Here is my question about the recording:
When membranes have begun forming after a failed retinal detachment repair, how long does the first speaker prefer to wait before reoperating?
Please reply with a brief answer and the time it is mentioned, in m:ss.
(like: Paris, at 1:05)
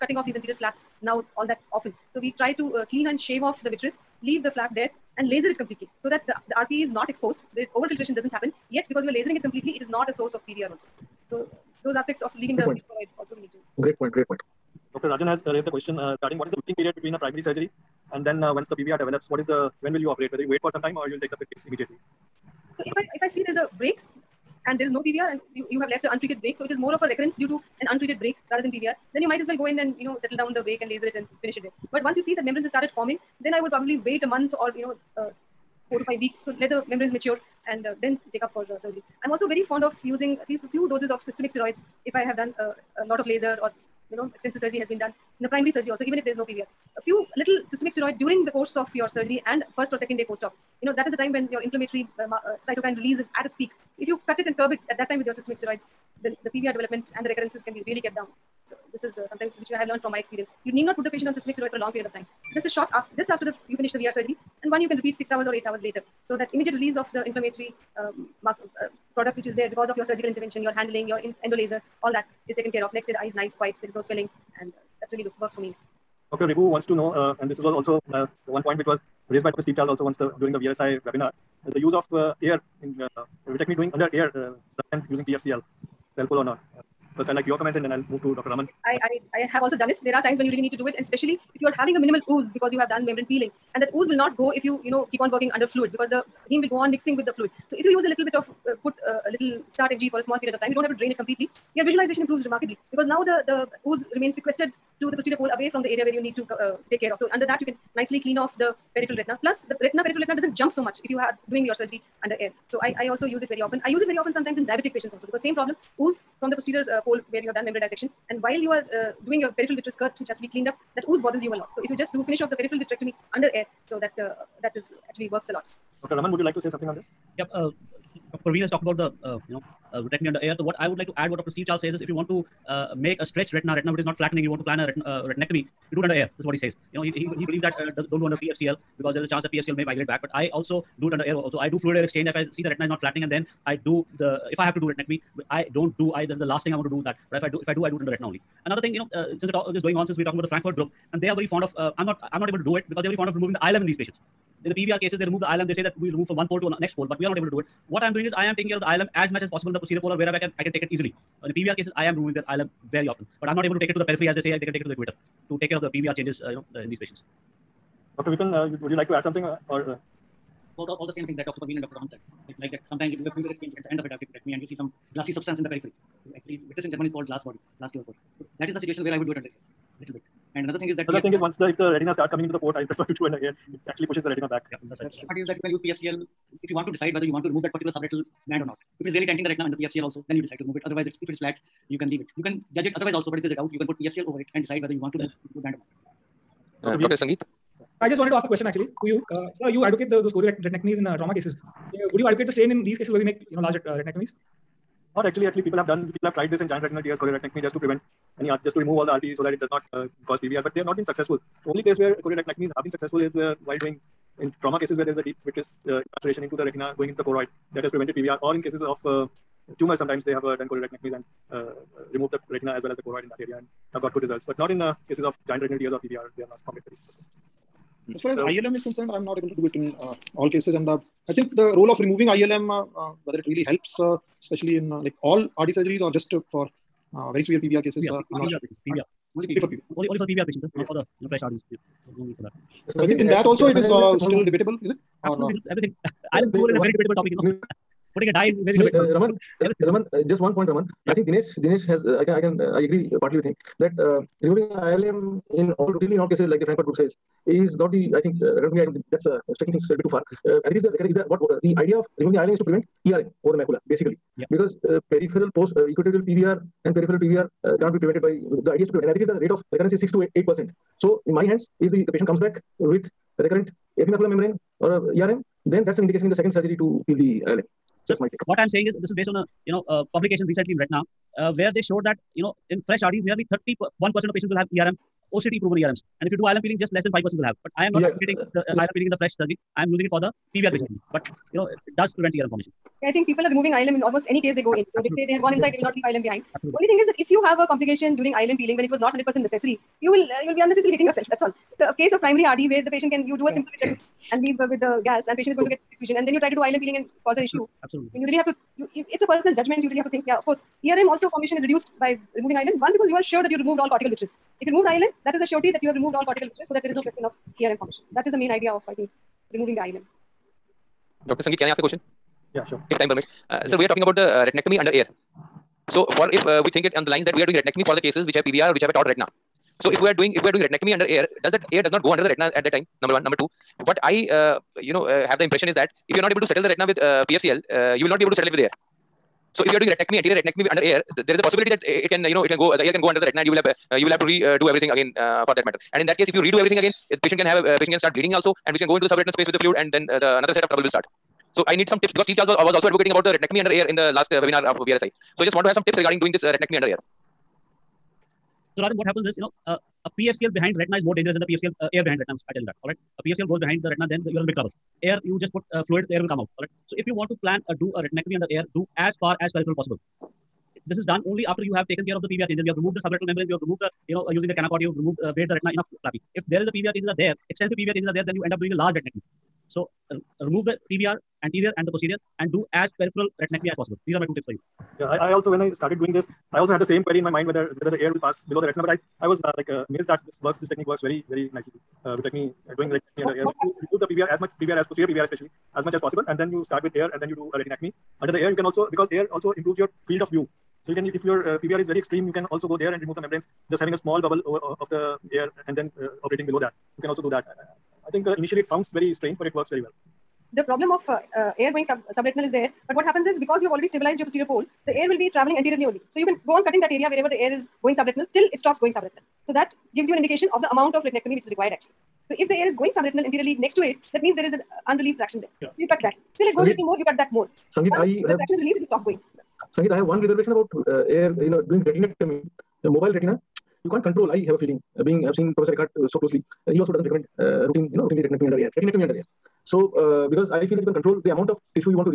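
4 to 5 weeks, at 0:35.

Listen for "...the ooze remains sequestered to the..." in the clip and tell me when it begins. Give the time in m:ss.
1:43.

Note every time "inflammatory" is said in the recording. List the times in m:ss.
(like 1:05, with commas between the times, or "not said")
0:51, 1:07.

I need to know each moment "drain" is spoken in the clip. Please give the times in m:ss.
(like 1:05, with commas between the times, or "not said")
1:40.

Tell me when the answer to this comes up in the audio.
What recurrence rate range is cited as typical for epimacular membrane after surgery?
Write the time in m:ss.
4:30.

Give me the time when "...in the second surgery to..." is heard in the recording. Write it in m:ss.
4:36.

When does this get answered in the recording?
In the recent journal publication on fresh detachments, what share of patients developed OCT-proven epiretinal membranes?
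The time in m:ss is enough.
4:43.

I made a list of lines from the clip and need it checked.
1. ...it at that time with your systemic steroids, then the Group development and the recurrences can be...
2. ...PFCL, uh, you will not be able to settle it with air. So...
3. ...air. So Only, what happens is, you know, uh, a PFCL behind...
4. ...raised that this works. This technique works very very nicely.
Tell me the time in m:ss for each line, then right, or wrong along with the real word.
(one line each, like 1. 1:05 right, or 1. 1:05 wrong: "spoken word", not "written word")
1. 0:54 wrong: "PVR", not "Group"
2. 5:37 right
3. 5:56 wrong: "Rajan", not "Only"
4. 6:29 wrong: "amazed", not "raised".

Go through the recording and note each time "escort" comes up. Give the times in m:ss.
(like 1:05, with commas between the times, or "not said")
not said.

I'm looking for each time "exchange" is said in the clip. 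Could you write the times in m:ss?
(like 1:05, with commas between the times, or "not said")
2:22, 2:53.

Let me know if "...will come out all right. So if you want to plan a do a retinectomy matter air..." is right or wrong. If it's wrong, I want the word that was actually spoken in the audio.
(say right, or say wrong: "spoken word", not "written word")
wrong: "under", not "matter".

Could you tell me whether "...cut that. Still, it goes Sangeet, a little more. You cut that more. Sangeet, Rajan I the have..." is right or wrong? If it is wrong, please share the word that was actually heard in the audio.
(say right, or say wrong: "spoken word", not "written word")
wrong: "Once", not "Rajan".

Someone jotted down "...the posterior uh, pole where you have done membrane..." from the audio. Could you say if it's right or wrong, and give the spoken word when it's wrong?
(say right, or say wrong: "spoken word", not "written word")
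right.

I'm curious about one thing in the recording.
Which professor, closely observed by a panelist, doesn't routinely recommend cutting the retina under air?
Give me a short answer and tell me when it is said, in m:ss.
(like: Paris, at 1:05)
Eckardt, at 7:15.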